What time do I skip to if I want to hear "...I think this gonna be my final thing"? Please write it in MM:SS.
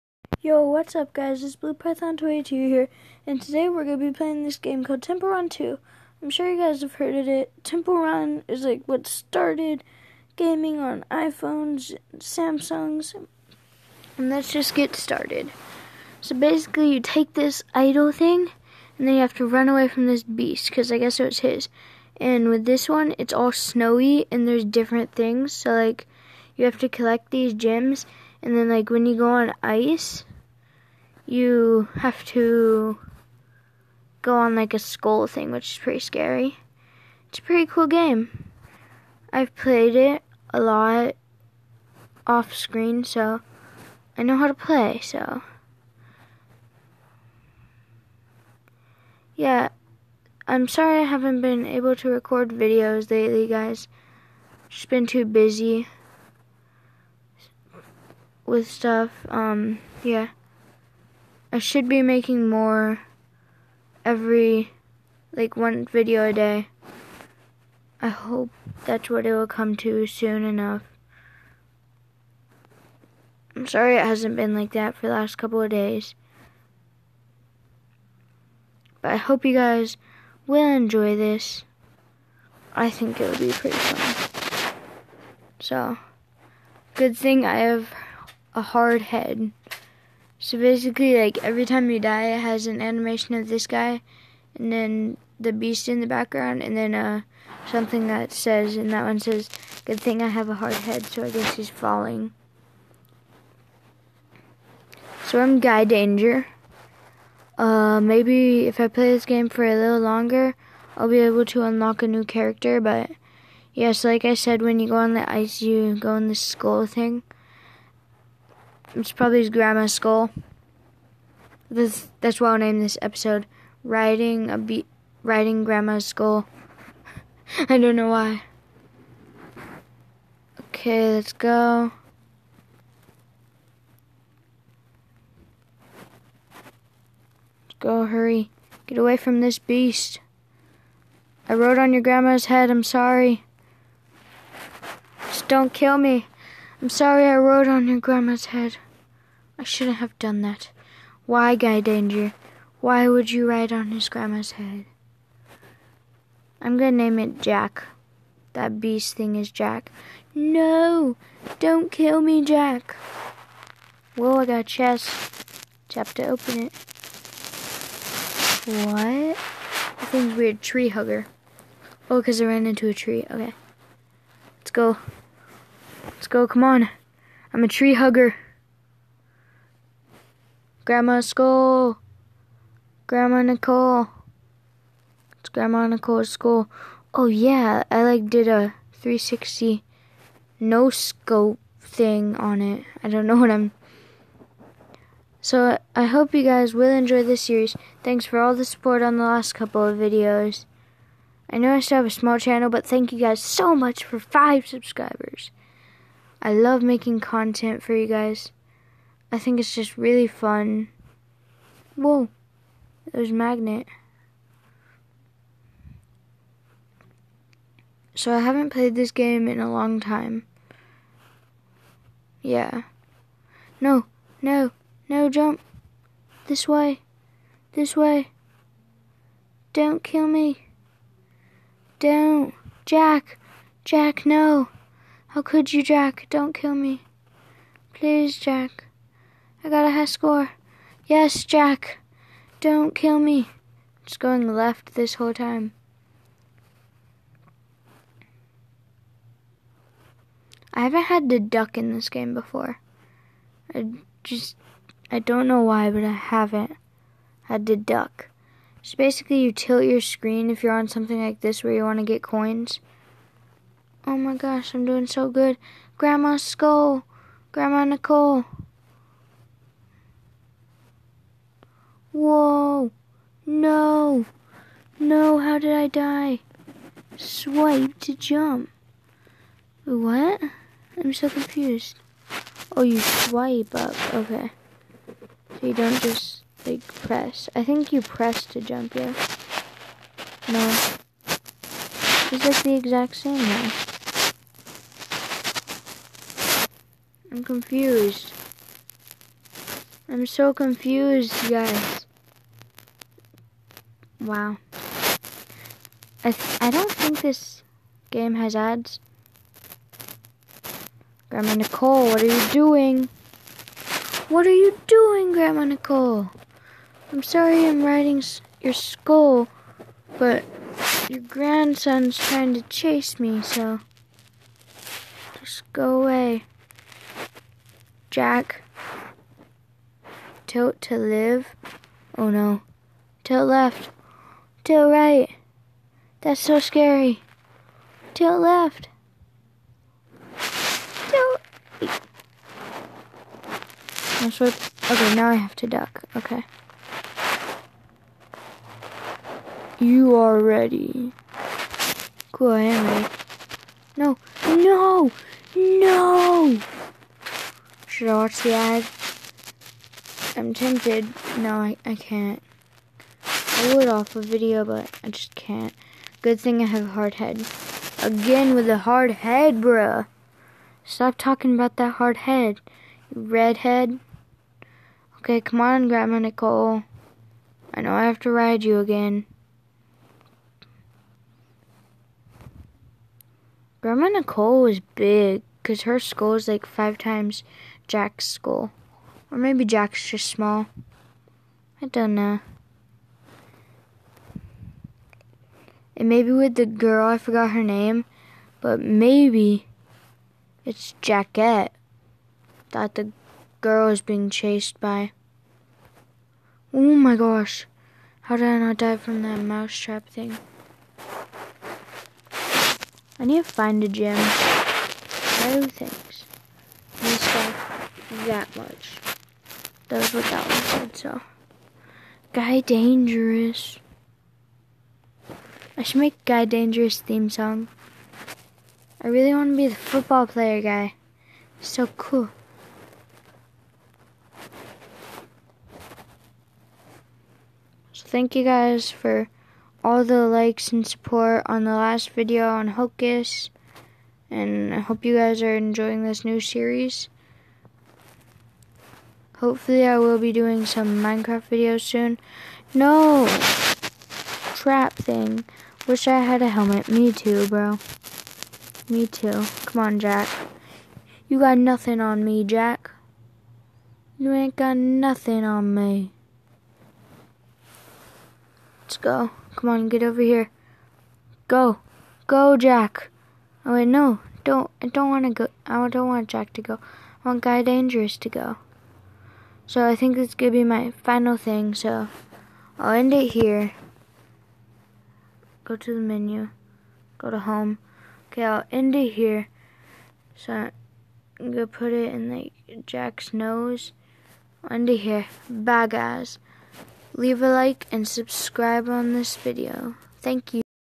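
07:59.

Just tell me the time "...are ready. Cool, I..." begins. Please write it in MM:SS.
05:50.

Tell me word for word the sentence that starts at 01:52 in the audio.
But yes, like I said, when you go on the ice, you go in the skull thing.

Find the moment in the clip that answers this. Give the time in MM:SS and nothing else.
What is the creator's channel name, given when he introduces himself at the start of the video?
00:01.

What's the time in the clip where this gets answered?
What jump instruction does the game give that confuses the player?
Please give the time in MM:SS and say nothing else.
04:37.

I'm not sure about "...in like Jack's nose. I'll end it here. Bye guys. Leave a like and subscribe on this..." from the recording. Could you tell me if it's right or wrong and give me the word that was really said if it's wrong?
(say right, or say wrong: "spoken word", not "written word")
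right.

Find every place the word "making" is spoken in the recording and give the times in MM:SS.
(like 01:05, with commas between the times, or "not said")
01:02, 03:26.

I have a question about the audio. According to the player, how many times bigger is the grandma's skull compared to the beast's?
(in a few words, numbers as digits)
5 times.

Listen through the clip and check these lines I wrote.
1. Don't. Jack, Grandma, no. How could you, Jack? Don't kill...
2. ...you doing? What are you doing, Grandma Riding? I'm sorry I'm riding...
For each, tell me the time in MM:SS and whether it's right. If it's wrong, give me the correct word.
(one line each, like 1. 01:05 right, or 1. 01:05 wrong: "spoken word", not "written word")
1. 03:51 wrong: "Jack", not "Grandma"
2. 05:12 wrong: "Nicole", not "Riding".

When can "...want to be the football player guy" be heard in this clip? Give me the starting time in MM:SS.
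07:09.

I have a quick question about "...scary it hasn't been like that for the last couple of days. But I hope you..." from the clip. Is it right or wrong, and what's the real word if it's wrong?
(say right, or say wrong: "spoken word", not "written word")
wrong: "sorry", not "scary".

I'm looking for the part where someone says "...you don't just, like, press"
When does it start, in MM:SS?
04:45.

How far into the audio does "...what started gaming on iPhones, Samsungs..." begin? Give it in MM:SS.
00:08.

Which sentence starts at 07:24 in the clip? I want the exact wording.
And I hope you guys are enjoying this new series.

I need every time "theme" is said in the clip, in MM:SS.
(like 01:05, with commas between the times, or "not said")
07:07.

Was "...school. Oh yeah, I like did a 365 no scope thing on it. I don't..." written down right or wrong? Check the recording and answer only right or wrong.
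wrong.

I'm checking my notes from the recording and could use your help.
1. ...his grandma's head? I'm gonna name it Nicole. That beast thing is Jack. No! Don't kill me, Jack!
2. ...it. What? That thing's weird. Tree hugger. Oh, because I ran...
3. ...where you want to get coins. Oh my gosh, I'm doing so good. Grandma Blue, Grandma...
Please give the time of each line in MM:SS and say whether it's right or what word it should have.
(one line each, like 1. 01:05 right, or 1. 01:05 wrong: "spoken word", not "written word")
1. 02:33 wrong: "Jack", not "Nicole"
2. 02:46 right
3. 04:21 wrong: "Skull", not "Blue".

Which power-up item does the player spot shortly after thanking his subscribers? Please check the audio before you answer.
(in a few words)
Magnet.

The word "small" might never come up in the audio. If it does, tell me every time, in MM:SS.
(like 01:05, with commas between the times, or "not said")
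03:22, 06:30.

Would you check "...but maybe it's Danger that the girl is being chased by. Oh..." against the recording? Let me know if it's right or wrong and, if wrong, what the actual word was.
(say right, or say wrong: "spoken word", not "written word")
wrong: "Jackette", not "Danger".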